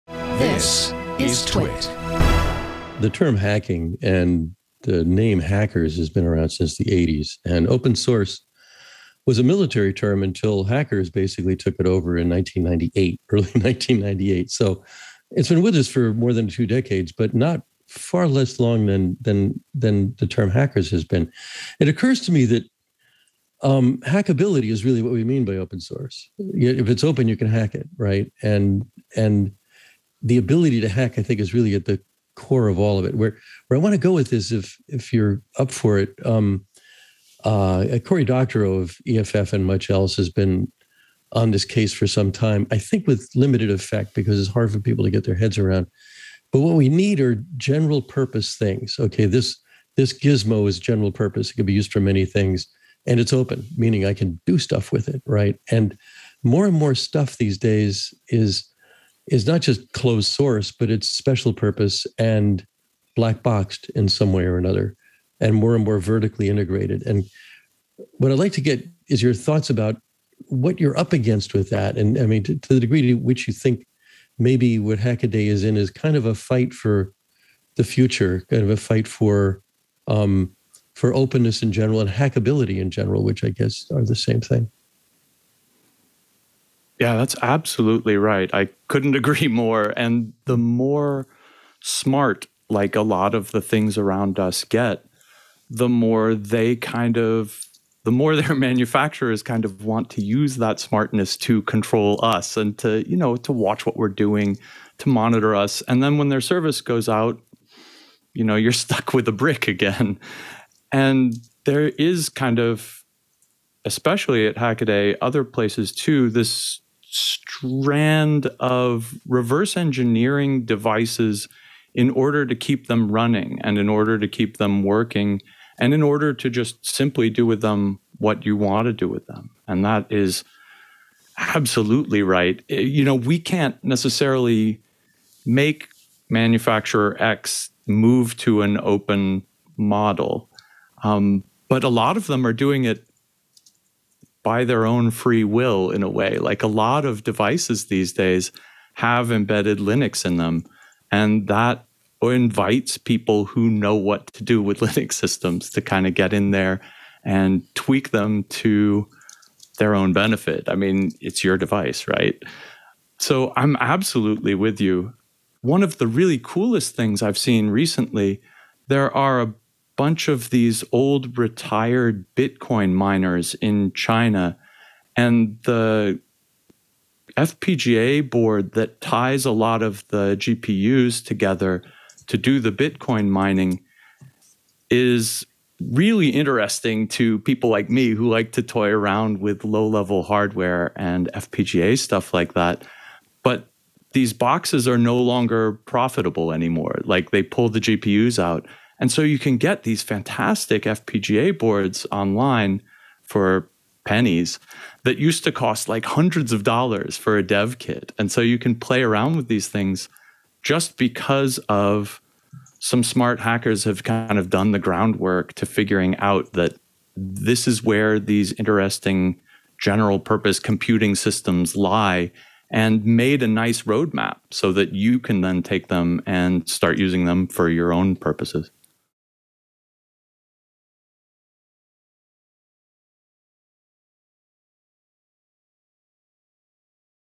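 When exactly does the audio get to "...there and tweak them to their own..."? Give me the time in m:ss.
2:36.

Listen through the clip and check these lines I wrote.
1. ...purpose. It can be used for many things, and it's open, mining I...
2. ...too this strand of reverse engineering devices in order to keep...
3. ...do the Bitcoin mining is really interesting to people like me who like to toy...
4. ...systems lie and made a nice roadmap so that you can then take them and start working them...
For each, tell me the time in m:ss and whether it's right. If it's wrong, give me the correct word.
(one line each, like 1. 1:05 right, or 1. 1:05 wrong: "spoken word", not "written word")
1. 0:51 wrong: "meaning", not "mining"
2. 1:55 right
3. 3:02 right
4. 3:41 wrong: "using", not "working".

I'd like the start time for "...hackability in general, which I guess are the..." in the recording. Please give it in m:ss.
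1:22.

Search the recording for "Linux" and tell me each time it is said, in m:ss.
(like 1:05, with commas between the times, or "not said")
2:29, 2:34.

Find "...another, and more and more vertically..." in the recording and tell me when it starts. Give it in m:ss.
1:04.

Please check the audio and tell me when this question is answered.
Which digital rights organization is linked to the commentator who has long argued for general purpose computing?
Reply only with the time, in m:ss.
0:39.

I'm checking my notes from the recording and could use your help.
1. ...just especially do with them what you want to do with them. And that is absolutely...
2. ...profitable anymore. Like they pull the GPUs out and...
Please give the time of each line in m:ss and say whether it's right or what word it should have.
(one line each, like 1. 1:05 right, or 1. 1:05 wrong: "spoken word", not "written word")
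1. 2:06 wrong: "simply", not "especially"
2. 3:15 right.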